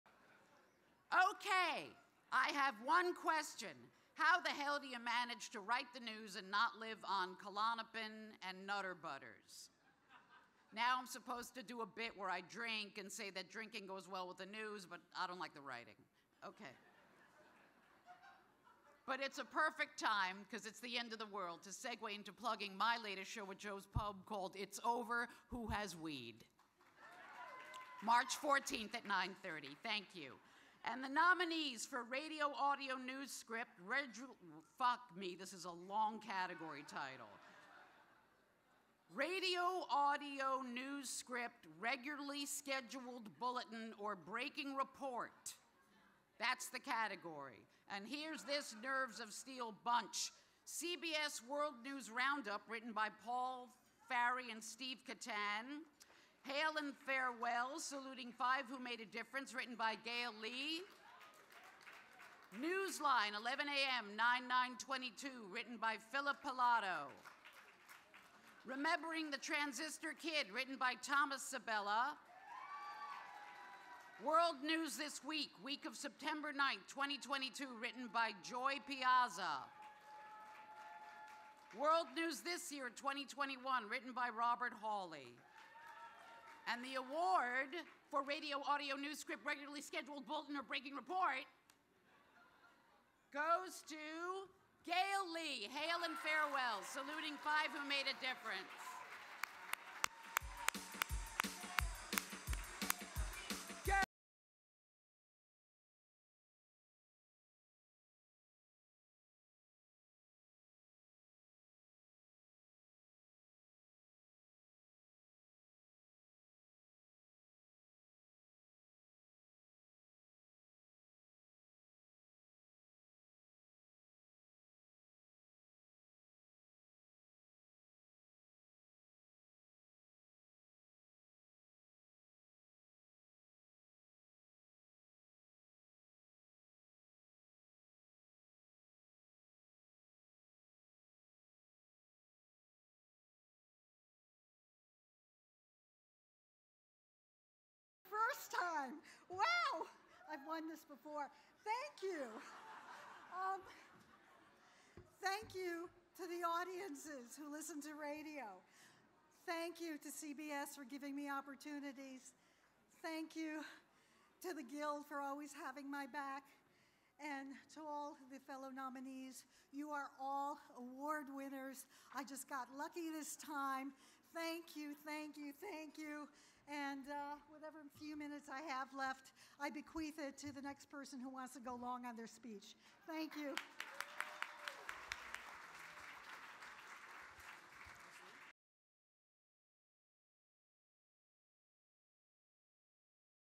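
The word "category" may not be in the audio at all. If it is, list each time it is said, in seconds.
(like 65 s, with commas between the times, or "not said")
36 s, 46 s.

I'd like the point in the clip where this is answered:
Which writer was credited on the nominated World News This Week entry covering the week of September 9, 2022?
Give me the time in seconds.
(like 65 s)
78 s.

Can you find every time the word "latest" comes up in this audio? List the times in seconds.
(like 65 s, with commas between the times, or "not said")
23 s.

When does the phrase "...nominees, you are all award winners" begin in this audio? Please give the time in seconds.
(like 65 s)
168 s.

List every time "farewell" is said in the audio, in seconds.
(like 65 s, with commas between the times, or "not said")
57 s, 96 s.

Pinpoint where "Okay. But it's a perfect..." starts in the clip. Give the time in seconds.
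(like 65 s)
16 s.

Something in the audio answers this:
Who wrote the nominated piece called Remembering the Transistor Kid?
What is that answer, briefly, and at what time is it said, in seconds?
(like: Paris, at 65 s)
Thomas Sabella, at 71 s.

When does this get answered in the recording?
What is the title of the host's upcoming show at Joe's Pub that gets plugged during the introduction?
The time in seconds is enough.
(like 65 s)
24 s.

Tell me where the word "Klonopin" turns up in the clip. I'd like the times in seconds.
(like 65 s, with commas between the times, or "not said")
7 s.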